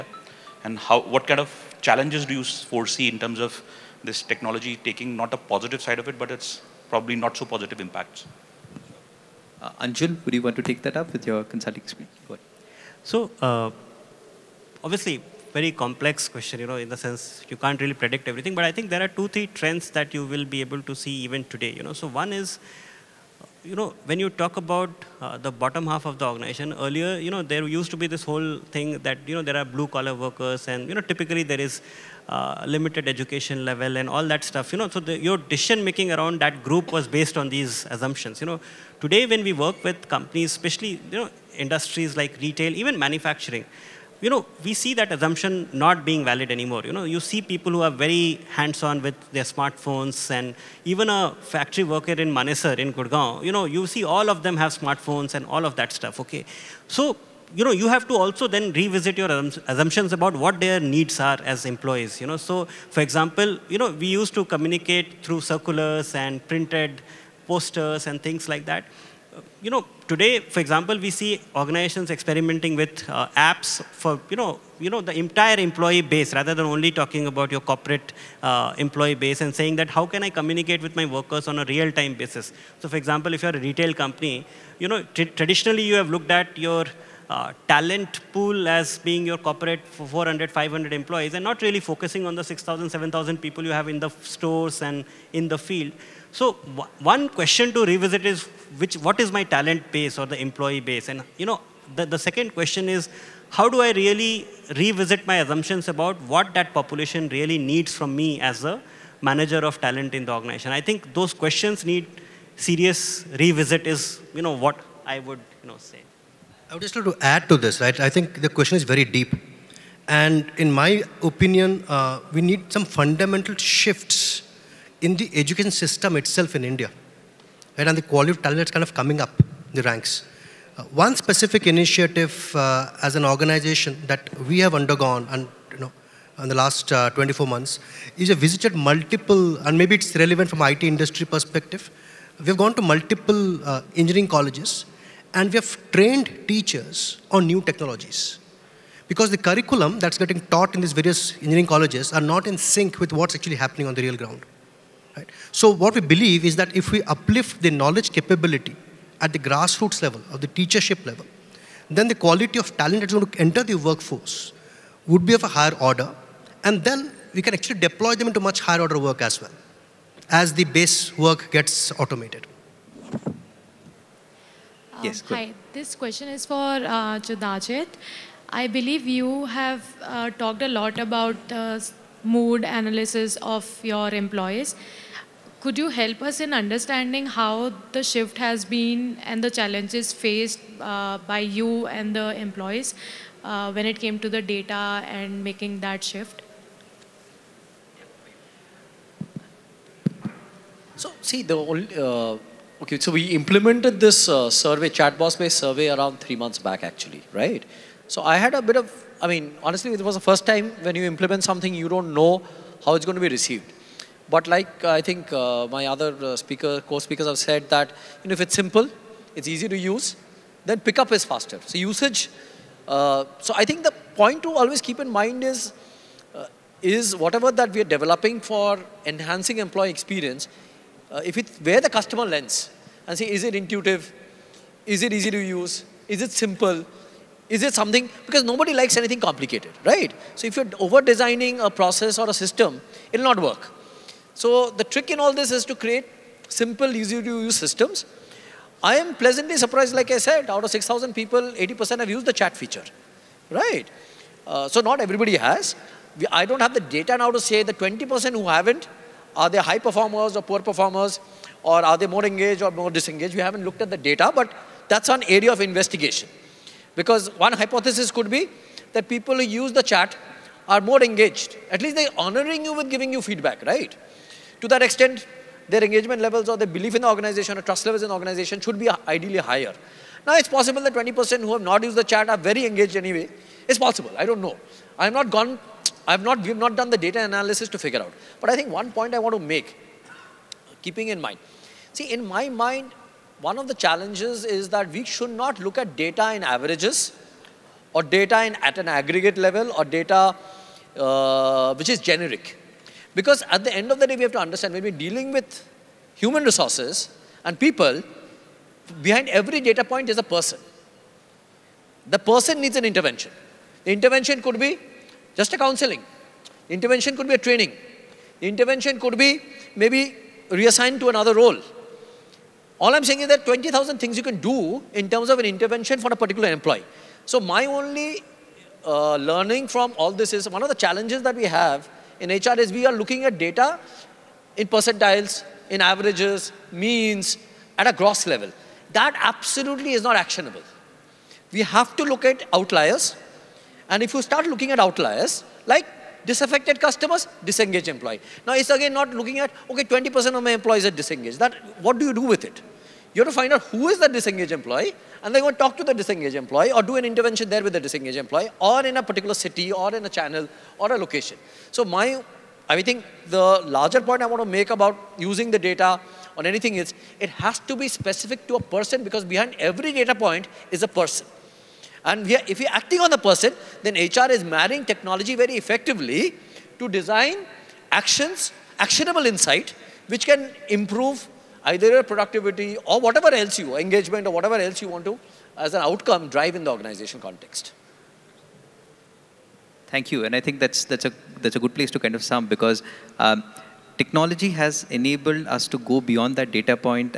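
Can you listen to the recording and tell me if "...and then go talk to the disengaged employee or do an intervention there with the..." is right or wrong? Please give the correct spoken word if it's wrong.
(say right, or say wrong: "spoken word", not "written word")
right.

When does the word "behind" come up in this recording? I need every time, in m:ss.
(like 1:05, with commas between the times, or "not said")
5:09, 6:09.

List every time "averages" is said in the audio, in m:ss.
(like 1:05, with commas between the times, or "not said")
4:56, 5:35.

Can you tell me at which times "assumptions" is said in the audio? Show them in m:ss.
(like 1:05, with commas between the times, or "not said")
0:37, 0:45, 0:59, 1:45.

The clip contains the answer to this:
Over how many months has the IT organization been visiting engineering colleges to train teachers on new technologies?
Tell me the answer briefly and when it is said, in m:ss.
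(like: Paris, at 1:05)
24 months, at 2:17.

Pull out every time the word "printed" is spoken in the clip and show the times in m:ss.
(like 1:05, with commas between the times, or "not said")
1:06.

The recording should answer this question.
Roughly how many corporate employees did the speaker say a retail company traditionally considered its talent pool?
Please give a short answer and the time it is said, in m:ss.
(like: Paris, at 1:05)
400 to 500, at 1:29.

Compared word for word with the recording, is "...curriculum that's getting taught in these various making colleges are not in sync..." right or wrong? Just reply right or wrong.
wrong.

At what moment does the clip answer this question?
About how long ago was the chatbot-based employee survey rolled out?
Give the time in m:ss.
3:26.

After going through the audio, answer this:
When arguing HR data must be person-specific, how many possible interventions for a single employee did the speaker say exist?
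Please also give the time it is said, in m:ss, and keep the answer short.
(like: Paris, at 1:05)
20,000, at 5:23.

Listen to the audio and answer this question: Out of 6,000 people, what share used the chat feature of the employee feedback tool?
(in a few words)
80%.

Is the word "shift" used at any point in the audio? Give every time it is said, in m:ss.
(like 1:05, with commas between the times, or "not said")
2:03, 3:08, 3:16.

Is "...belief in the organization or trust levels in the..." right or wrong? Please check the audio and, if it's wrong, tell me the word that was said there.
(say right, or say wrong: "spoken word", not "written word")
right.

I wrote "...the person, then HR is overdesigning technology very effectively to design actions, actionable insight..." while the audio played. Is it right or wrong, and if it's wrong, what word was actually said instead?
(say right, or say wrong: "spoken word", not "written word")
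wrong: "marrying", not "overdesigning".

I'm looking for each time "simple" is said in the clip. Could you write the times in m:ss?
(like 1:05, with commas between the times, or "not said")
3:38, 3:56, 4:06.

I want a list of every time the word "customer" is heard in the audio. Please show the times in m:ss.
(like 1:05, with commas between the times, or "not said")
3:51, 5:46.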